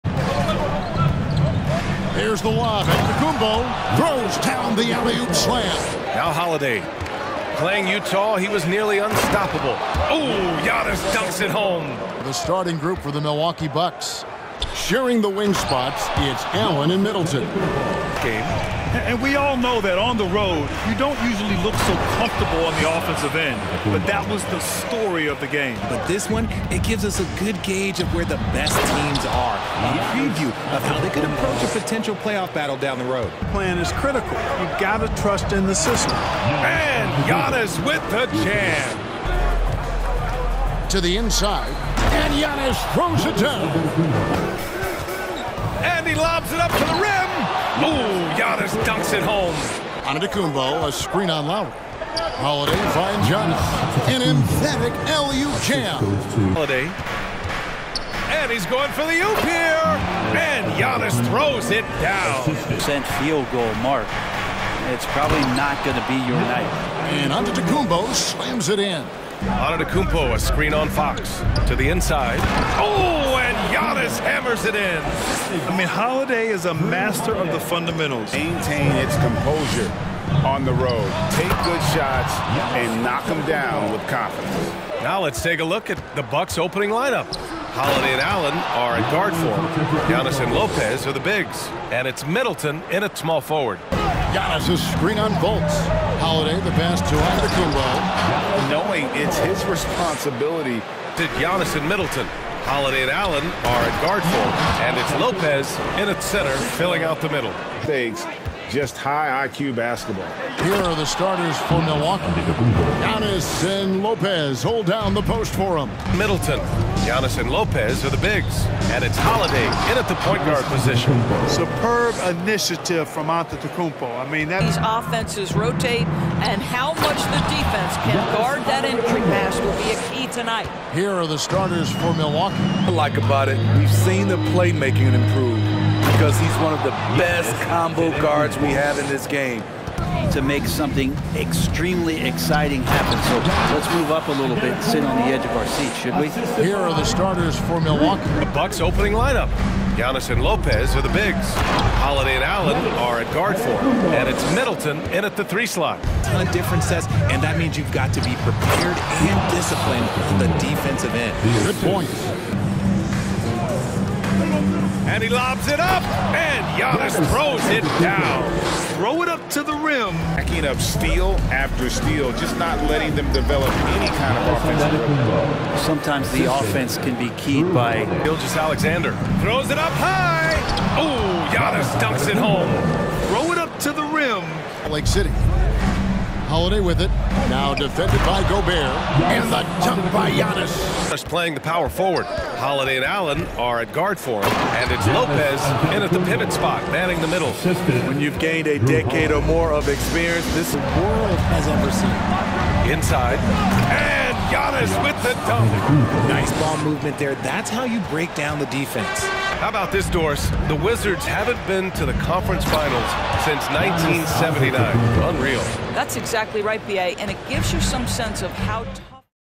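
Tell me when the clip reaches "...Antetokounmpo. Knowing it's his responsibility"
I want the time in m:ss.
1:38.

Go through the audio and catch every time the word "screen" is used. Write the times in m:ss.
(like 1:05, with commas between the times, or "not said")
0:50, 1:10, 1:34.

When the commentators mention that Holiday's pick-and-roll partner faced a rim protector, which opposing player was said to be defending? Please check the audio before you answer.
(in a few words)
Gobert.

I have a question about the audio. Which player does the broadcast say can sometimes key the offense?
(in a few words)
Gilgeous-Alexander.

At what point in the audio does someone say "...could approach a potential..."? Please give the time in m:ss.
0:31.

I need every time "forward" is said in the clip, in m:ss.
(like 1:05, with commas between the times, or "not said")
1:33, 3:11.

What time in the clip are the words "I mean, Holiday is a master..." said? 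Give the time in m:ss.
1:15.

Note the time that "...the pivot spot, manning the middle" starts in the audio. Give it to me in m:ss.
3:16.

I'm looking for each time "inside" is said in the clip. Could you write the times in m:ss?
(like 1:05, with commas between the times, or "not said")
0:41, 1:11, 3:22.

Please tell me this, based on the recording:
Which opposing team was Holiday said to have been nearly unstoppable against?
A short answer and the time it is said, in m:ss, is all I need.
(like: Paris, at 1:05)
Utah, at 0:07.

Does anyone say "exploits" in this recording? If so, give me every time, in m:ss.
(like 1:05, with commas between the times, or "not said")
not said.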